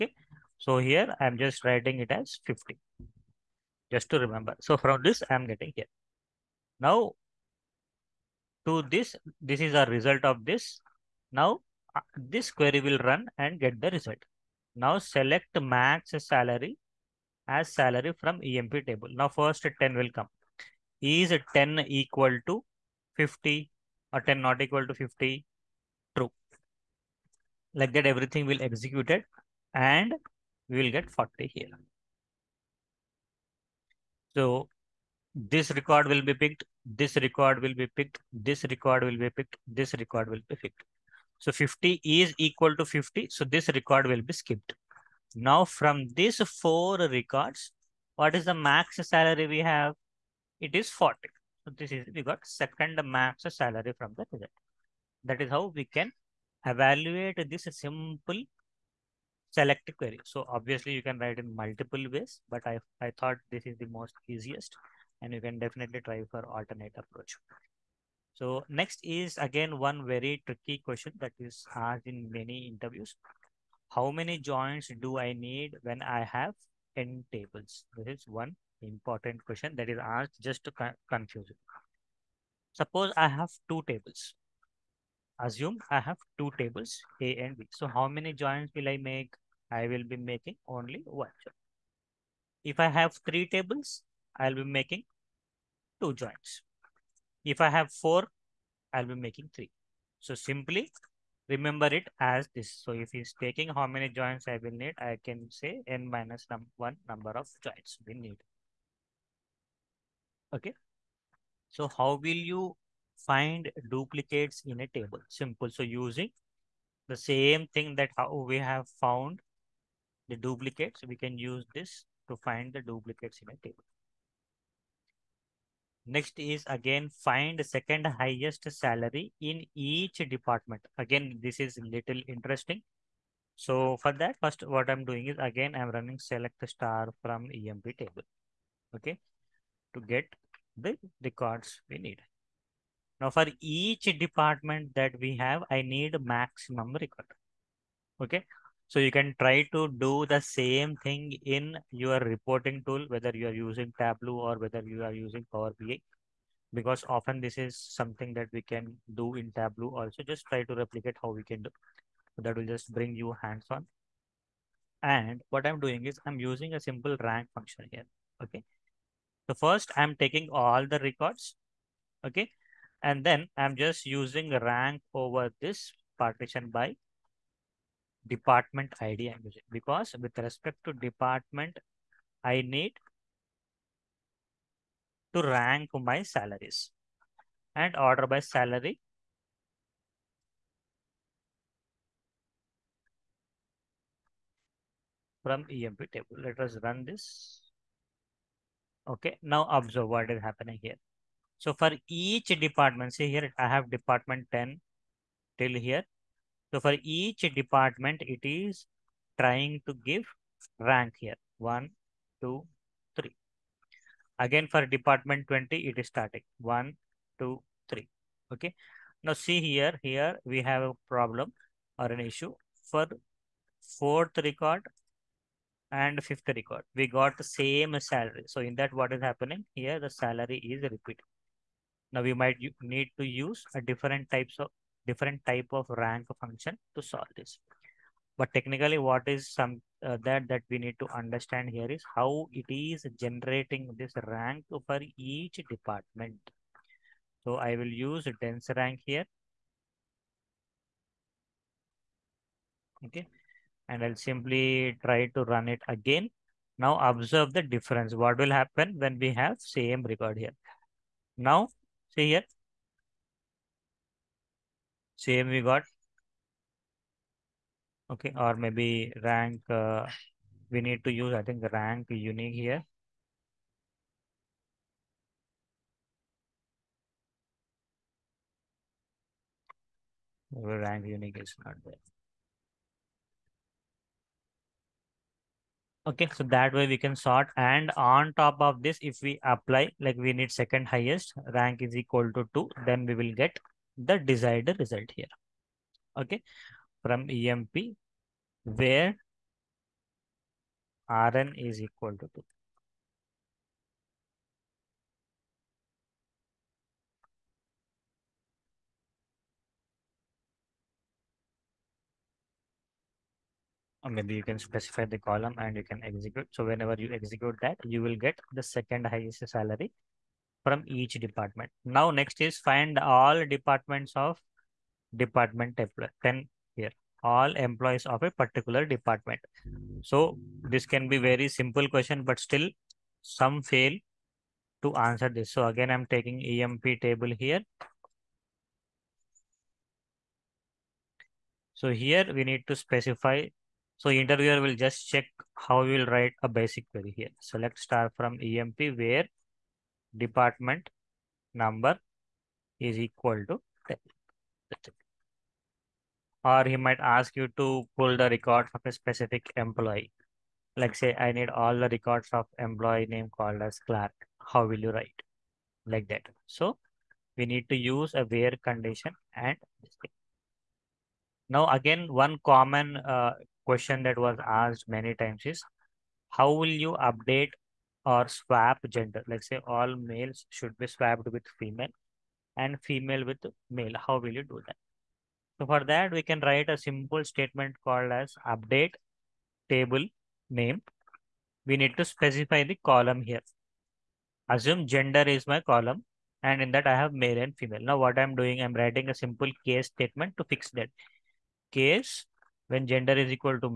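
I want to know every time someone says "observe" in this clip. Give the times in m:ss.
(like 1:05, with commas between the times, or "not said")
3:19, 4:17.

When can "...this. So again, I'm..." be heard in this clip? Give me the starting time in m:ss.
5:35.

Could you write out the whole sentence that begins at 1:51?
So how will you find duplicates in a table?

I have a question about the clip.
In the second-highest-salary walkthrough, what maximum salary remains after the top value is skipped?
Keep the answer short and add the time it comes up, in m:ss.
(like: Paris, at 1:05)
40, at 0:50.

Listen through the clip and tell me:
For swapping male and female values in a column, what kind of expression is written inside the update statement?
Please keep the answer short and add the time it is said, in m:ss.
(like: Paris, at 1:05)
case statement, at 6:39.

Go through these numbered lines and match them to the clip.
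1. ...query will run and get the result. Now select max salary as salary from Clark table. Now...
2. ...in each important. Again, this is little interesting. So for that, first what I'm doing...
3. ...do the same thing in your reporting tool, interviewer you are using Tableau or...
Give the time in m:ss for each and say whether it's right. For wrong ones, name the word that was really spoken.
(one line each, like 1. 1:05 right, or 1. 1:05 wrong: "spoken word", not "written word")
1. 0:12 wrong: "EMP", not "Clark"
2. 2:09 wrong: "department", not "important"
3. 2:29 wrong: "whether", not "interviewer".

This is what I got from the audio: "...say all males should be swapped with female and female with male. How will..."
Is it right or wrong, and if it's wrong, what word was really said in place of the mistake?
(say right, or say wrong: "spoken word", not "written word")
right.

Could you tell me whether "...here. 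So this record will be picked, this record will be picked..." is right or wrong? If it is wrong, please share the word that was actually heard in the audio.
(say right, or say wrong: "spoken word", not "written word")
right.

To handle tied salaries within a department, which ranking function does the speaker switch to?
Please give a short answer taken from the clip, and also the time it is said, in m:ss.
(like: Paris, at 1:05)
dense rank, at 4:08.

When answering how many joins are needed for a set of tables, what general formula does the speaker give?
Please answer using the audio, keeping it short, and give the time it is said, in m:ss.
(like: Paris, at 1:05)
n minus 1, at 1:45.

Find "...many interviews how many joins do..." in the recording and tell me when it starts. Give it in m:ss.
1:12.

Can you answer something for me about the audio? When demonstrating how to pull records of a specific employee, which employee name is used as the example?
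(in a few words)
Clark.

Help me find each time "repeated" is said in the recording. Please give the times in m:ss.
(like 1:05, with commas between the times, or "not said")
3:50.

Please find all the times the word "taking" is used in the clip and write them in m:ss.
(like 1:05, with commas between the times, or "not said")
1:43, 2:50, 5:36.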